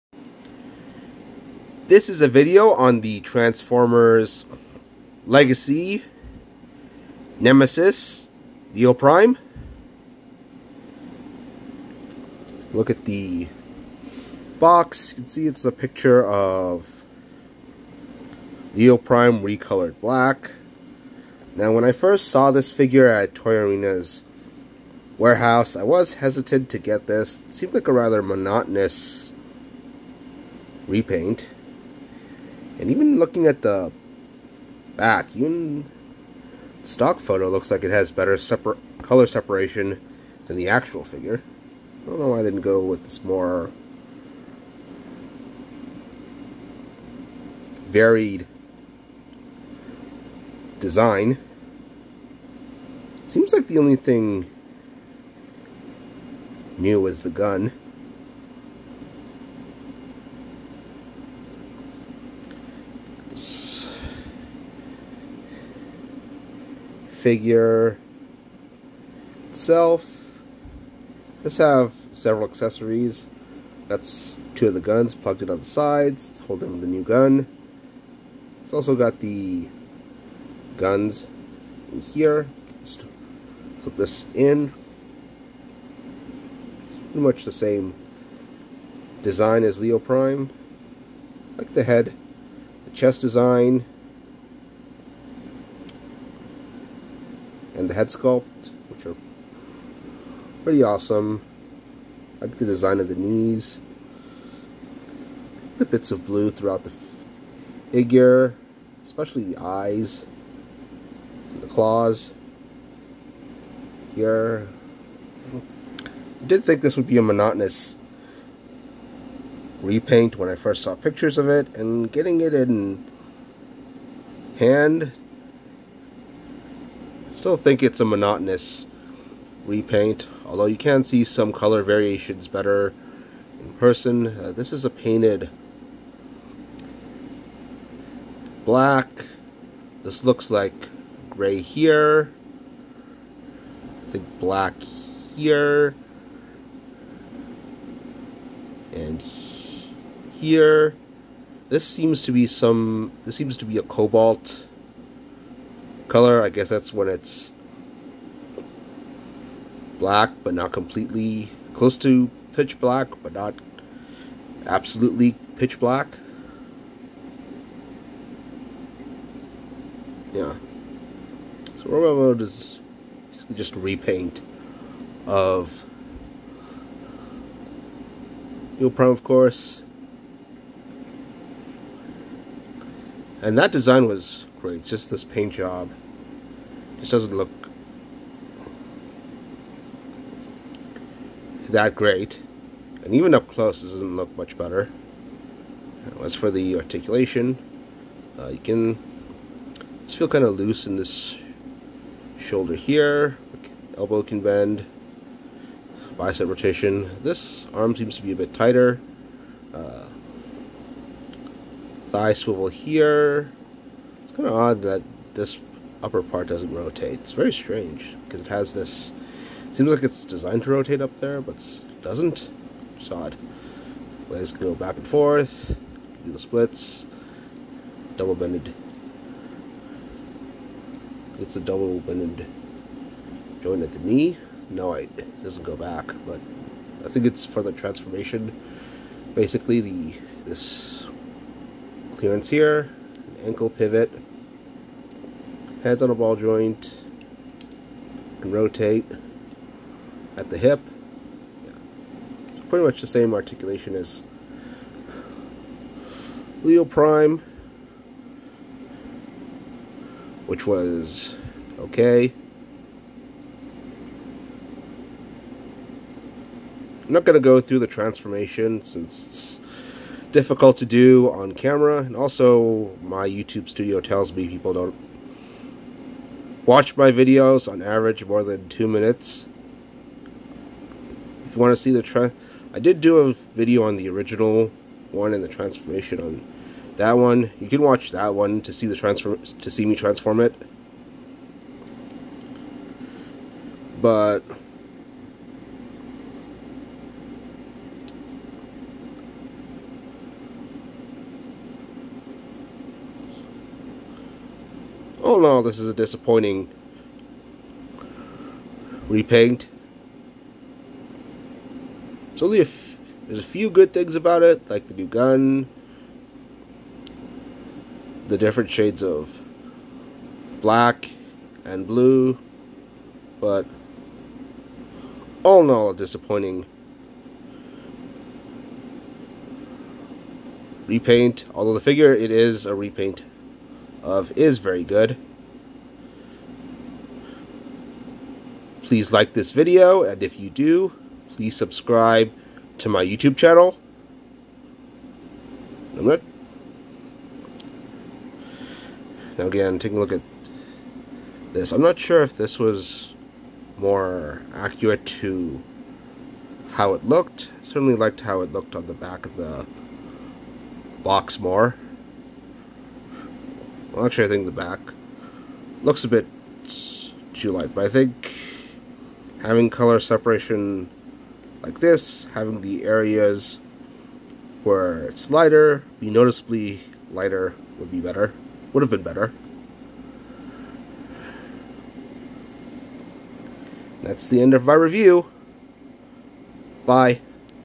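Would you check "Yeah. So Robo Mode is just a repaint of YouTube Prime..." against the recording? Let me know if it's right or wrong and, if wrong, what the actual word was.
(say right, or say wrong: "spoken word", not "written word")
wrong: "Leo", not "YouTube".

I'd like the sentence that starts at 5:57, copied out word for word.
Certainly liked how it looked on the back of the box more.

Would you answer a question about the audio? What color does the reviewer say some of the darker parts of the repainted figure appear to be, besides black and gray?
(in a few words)
cobalt.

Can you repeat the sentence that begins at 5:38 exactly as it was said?
Please like this video, and if you do, please subscribe to my YouTube channel.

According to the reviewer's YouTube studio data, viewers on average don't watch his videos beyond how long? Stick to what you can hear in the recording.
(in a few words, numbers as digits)
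2 minutes.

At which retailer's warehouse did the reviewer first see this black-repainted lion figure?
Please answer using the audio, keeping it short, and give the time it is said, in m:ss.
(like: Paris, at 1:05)
Toy Arena, at 0:23.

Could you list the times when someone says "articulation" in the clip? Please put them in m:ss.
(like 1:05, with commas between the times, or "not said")
3:16, 4:13.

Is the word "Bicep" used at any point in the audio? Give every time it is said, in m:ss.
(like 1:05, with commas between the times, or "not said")
3:26.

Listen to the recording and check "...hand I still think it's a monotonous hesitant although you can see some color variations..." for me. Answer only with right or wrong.
wrong.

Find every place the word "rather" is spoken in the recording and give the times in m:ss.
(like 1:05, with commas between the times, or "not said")
0:27.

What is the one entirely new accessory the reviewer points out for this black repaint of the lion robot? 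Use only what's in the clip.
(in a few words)
the gun.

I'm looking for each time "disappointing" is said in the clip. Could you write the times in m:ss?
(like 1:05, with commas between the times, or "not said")
5:05, 5:25.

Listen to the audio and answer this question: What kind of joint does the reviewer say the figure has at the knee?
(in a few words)
double bended joint.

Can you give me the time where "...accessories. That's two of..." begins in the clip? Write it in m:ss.
1:12.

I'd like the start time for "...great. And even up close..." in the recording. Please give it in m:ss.
3:11.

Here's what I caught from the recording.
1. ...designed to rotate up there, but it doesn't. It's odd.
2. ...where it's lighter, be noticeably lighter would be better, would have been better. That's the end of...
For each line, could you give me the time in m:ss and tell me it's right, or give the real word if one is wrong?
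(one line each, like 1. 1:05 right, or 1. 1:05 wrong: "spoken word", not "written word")
1. 3:40 right
2. 6:14 right.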